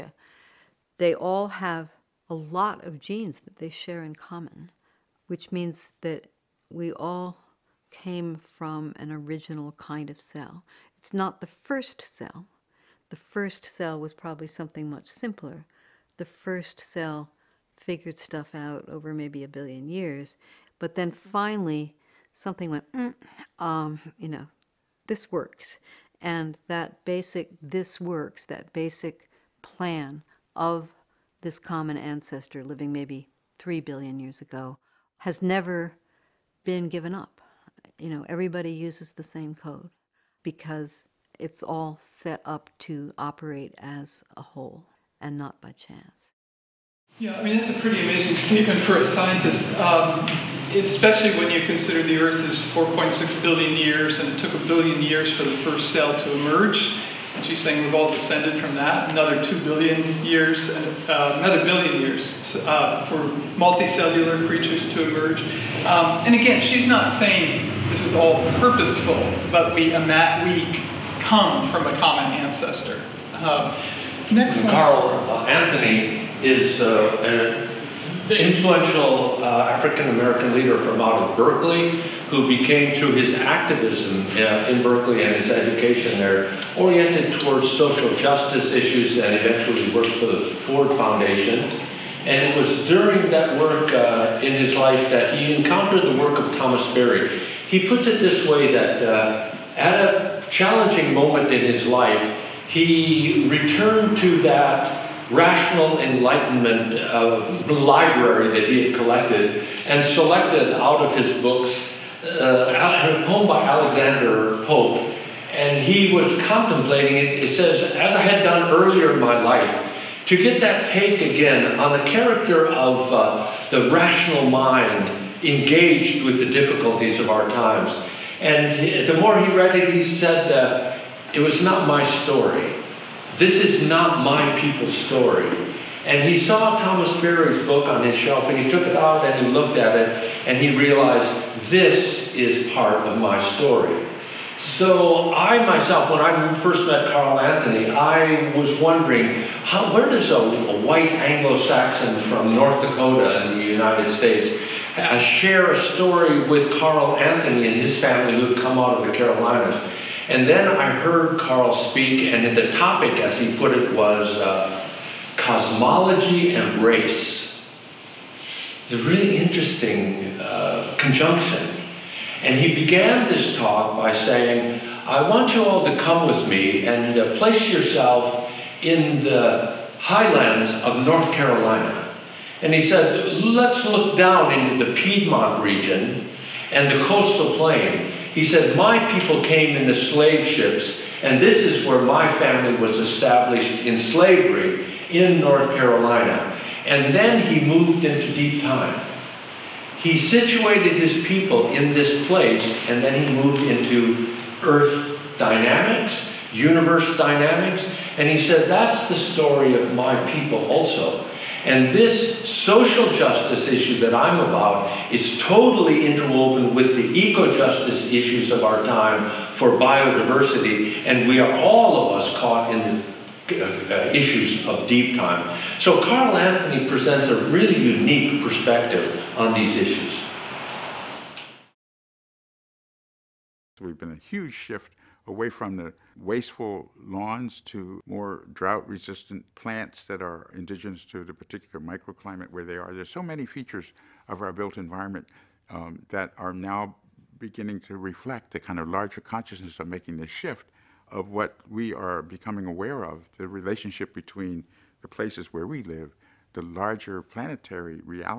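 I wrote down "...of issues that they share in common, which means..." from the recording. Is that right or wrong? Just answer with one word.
wrong.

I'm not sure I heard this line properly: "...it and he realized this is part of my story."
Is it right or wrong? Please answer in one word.
right.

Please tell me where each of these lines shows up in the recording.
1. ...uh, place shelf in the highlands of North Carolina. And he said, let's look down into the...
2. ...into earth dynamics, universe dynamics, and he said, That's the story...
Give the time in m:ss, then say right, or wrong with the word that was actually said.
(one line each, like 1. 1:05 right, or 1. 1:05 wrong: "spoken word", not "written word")
1. 2:57 wrong: "yourself", not "shelf"
2. 3:23 right.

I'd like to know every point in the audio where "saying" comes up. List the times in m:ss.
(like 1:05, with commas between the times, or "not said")
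0:57, 1:07, 2:54.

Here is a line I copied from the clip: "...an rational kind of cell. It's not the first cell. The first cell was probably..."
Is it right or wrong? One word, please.
wrong.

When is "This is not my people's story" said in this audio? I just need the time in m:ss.
2:13.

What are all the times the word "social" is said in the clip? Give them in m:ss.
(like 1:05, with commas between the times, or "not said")
1:27, 3:32.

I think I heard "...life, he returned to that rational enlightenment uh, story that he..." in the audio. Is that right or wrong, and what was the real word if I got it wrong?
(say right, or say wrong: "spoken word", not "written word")
wrong: "library", not "story".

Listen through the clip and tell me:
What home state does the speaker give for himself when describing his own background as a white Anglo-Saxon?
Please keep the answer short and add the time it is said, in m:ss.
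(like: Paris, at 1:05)
North Dakota, at 2:32.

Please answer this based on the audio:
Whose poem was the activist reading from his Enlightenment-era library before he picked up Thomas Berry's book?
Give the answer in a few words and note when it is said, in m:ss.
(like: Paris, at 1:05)
Alexander Pope, at 1:53.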